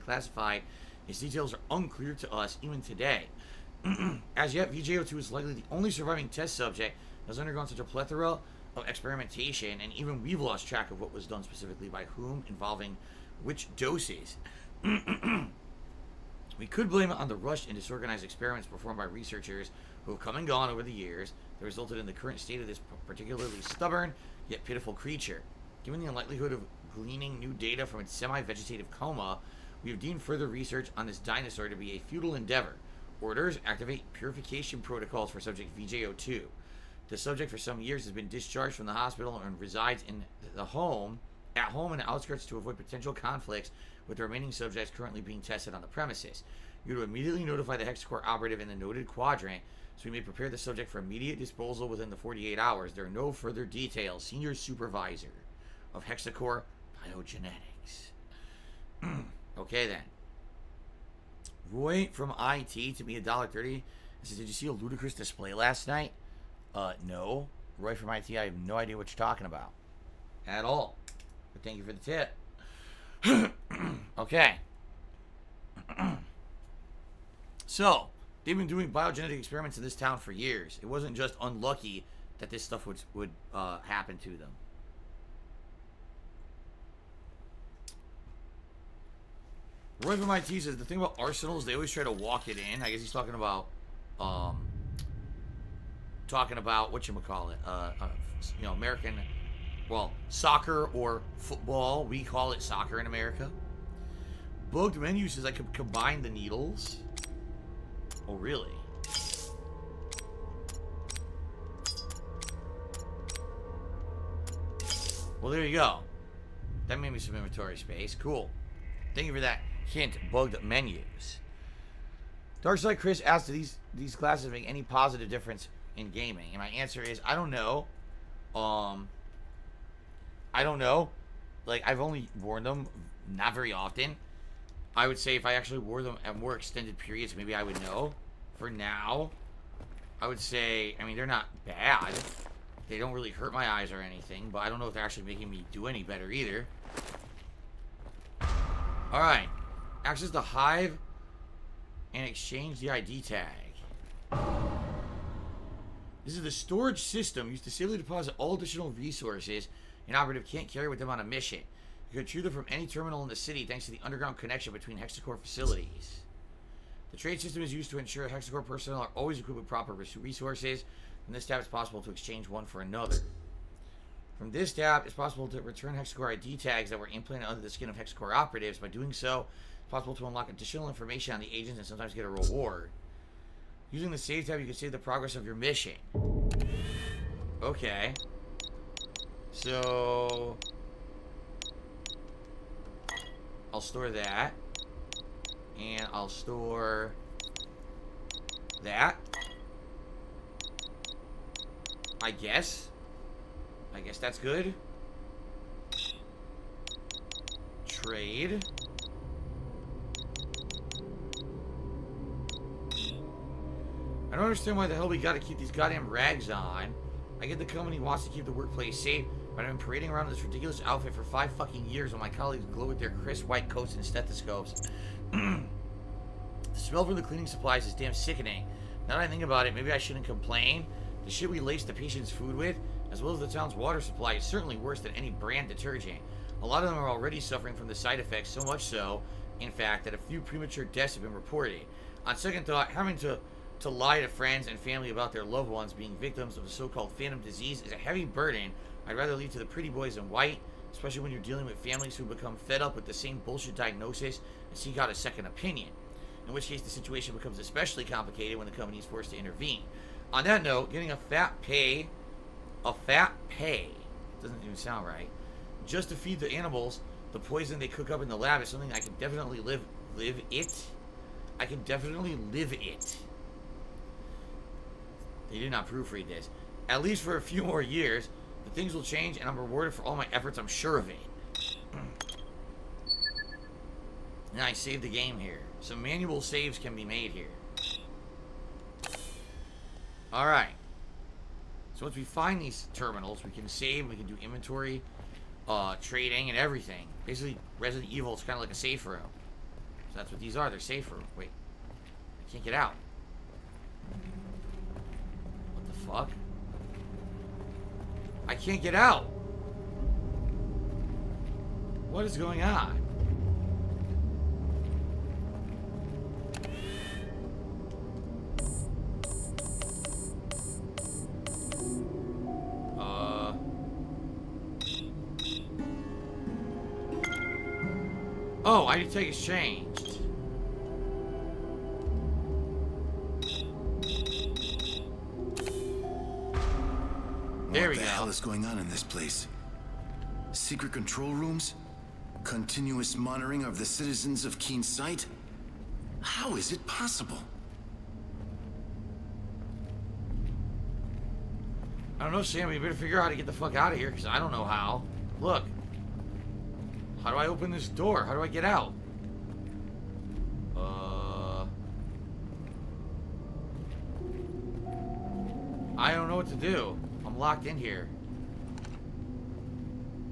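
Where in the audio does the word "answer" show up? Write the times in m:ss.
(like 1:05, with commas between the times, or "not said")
2:06.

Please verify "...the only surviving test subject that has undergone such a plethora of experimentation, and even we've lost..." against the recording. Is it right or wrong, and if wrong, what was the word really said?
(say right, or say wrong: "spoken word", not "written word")
right.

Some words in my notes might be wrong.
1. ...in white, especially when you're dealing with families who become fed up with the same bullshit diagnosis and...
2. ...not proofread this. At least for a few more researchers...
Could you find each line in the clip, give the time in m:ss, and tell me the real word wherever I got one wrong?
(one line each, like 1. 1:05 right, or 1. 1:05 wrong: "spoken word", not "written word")
1. 4:10 right
2. 4:35 wrong: "years", not "researchers".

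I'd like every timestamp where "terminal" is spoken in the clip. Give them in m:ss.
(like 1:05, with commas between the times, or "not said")
2:42, 4:52.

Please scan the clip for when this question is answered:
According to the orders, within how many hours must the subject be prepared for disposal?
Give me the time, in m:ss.
0:52.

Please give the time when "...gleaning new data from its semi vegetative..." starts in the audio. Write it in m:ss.
0:26.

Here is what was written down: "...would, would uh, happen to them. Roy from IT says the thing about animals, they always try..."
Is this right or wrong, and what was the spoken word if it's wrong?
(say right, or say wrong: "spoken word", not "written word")
wrong: "arsenals", not "animals".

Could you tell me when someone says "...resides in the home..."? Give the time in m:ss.
0:39.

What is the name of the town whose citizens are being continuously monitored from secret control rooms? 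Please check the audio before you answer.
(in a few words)
Keen Sight.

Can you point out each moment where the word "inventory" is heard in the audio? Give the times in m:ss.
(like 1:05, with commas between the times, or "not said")
1:57, 4:54.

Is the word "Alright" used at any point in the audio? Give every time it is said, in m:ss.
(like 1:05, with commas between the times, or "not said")
2:29, 4:50.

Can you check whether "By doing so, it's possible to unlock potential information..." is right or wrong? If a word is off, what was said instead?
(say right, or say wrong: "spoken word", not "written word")
wrong: "additional", not "potential".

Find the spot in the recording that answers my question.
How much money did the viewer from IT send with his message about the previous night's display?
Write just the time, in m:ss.
1:03.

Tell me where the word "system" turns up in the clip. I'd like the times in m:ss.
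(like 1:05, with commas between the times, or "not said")
2:37, 2:47.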